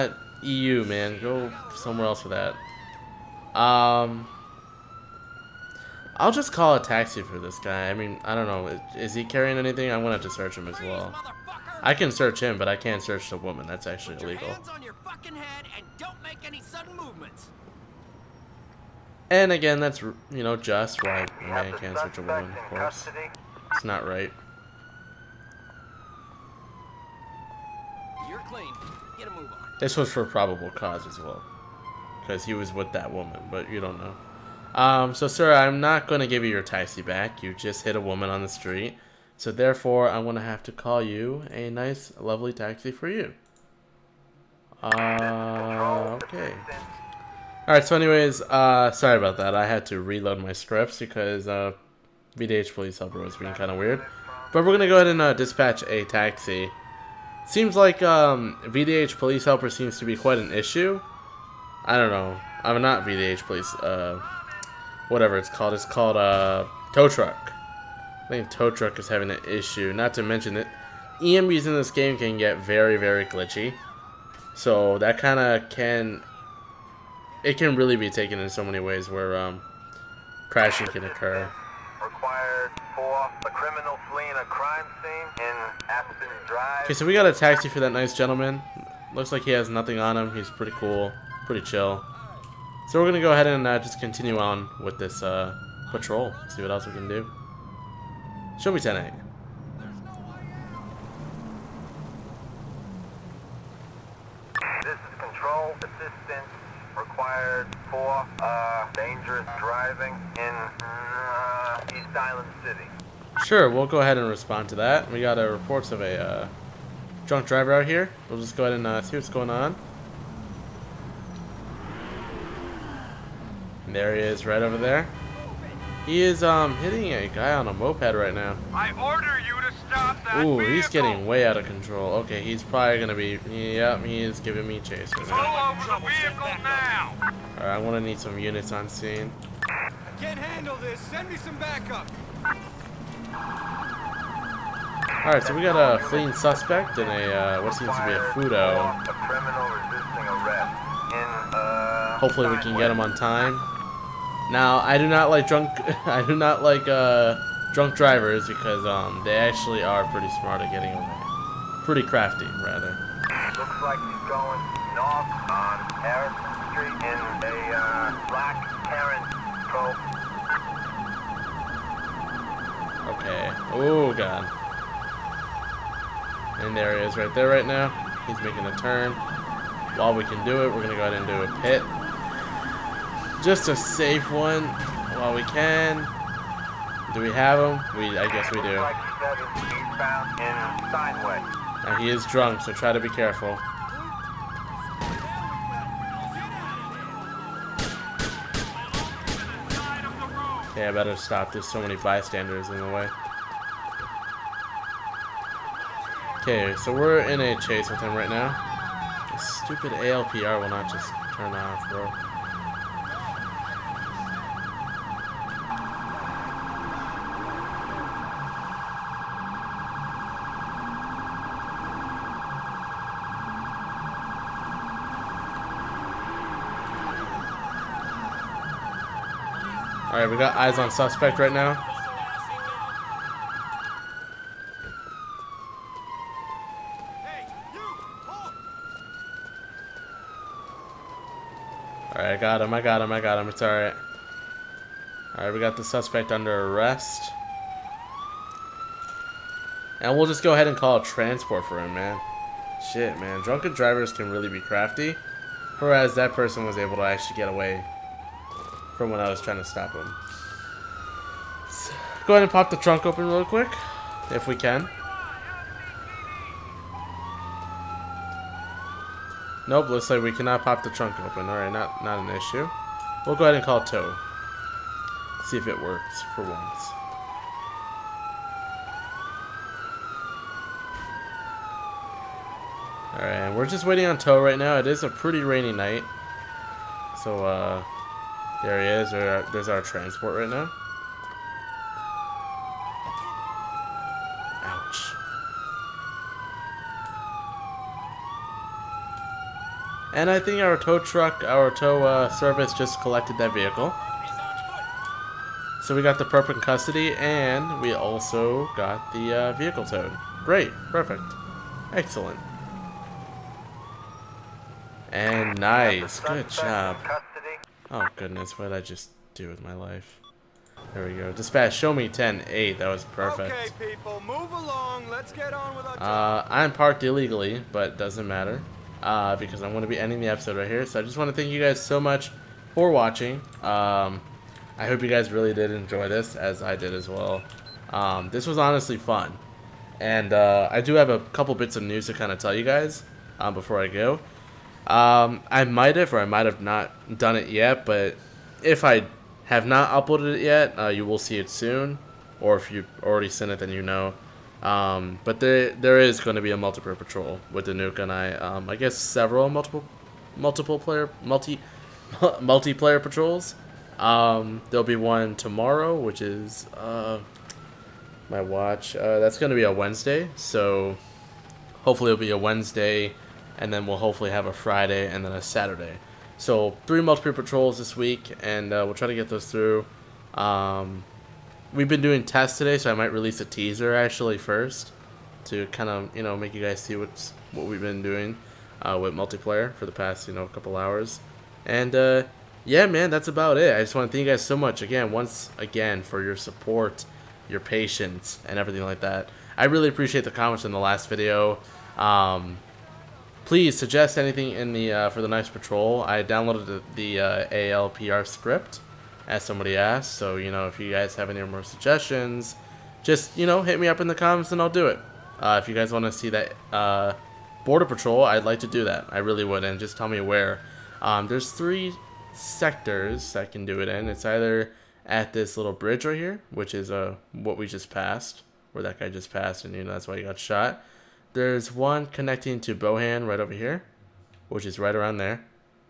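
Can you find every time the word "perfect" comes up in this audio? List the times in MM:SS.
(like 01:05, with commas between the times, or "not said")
05:10, 05:23.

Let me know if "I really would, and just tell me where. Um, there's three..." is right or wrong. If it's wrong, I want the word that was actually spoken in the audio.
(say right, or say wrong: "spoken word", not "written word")
right.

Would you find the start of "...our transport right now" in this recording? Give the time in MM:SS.
04:49.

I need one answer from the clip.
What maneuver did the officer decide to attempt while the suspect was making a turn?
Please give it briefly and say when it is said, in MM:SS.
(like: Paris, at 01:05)
A pit, at 03:01.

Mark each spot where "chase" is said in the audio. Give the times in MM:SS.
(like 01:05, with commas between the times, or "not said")
02:14, 03:27.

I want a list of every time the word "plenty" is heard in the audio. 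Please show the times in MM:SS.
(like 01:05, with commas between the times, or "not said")
not said.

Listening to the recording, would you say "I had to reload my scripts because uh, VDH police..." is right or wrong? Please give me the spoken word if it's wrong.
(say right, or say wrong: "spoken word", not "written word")
right.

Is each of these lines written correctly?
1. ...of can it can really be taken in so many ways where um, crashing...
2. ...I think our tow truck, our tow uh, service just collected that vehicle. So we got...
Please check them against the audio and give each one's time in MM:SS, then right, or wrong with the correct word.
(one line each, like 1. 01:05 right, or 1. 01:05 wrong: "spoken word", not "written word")
1. 01:15 right
2. 05:00 right.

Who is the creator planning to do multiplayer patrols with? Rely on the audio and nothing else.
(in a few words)
Wanduke.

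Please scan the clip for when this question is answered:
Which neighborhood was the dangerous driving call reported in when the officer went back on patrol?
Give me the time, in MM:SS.
01:51.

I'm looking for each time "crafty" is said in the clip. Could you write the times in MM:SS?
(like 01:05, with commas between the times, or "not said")
02:42, 04:14.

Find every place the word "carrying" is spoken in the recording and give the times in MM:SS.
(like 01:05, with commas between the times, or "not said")
00:09.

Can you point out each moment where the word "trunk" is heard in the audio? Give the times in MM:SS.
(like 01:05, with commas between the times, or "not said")
04:22, 04:30.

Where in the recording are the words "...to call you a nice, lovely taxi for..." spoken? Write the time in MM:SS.
00:40.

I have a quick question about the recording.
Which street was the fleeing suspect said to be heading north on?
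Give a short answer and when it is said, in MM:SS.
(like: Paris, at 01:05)
Harrison Street, at 02:46.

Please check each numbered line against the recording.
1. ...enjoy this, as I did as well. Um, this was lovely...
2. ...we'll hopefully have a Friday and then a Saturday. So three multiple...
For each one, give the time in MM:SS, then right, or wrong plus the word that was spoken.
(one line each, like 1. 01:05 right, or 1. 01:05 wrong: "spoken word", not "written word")
1. 05:35 wrong: "honestly", not "lovely"
2. 06:13 right.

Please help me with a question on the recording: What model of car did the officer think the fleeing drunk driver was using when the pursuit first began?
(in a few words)
Futo.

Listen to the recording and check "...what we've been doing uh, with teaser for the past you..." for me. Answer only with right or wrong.
wrong.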